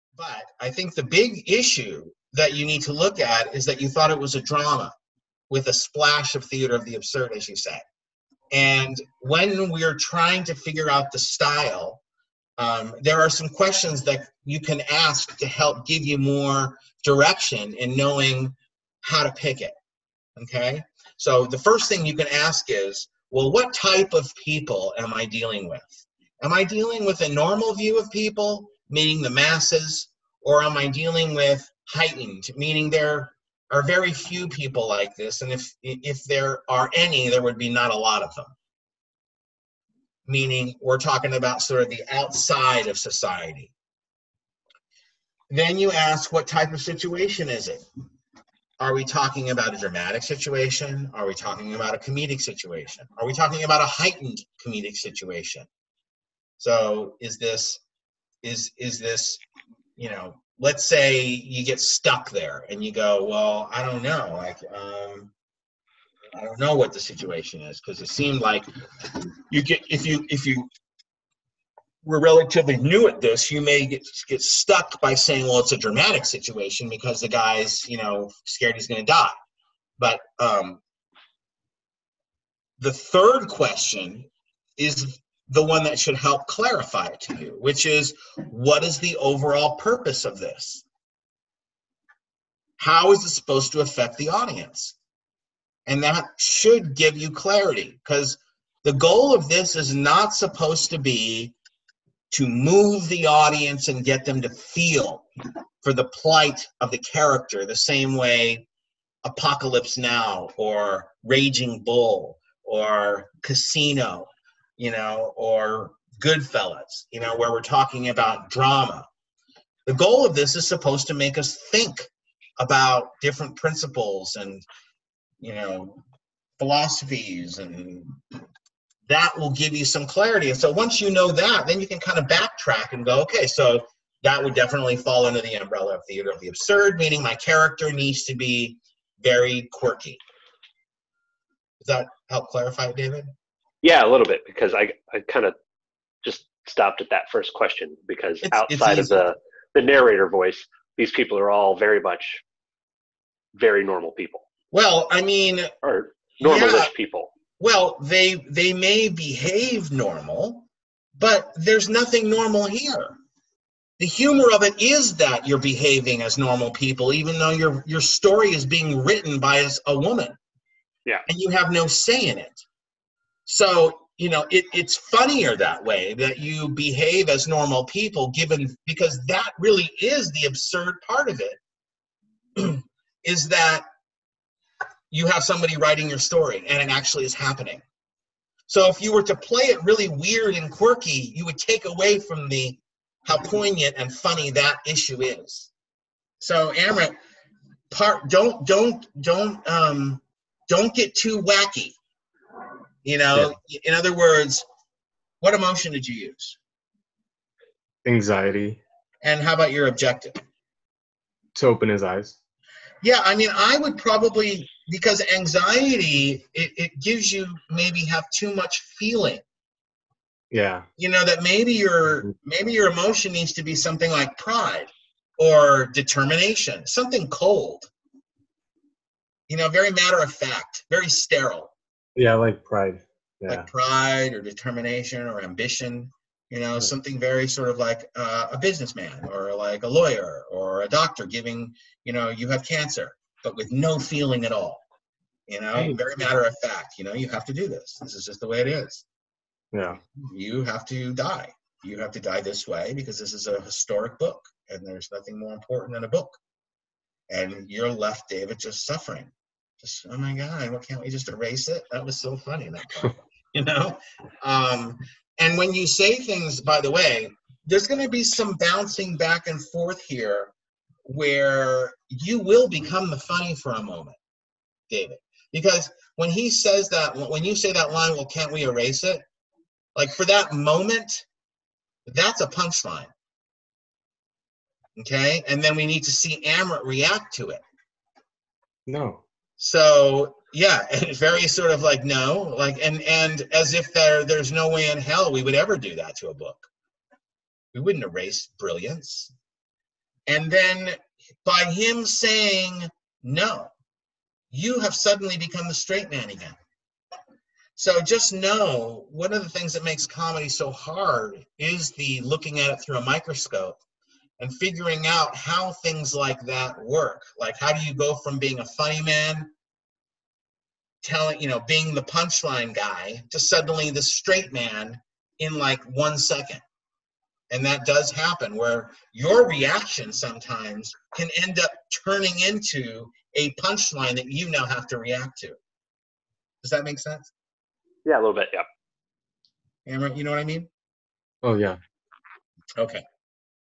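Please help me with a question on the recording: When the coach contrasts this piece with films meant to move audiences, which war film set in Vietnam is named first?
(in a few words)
Apocalypse Now.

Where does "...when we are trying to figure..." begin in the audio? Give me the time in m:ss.
0:09.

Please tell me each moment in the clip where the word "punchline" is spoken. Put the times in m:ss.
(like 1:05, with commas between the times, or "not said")
4:42, 5:22, 5:33.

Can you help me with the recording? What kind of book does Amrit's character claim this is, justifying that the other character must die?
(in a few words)
a historic book.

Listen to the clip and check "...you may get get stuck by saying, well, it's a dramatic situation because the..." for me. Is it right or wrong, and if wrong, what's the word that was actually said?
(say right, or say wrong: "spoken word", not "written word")
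right.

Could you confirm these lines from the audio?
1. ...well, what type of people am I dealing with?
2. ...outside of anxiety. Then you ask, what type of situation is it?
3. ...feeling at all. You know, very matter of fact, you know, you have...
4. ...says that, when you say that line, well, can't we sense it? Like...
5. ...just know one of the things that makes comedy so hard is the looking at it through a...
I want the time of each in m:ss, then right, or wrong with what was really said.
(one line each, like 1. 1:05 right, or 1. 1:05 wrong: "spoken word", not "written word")
1. 0:23 right
2. 0:42 wrong: "society", not "anxiety"
3. 4:03 right
4. 4:36 wrong: "erase", not "sense"
5. 5:08 right.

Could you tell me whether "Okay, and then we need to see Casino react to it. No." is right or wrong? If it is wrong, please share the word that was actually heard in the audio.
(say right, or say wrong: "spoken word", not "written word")
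wrong: "Amrit", not "Casino".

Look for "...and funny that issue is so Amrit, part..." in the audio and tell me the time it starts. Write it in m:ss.
3:13.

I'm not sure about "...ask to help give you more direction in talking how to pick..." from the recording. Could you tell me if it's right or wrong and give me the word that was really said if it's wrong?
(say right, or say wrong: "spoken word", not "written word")
wrong: "knowing", not "talking".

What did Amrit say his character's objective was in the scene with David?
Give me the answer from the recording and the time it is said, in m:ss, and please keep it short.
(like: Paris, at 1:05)
To open his eyes, at 3:31.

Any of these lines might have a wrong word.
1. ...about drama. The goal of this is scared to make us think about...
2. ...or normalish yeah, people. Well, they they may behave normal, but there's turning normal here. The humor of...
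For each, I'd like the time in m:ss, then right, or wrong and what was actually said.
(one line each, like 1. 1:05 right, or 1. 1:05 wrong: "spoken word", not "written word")
1. 1:58 wrong: "supposed", not "scared"
2. 2:35 wrong: "nothing", not "turning".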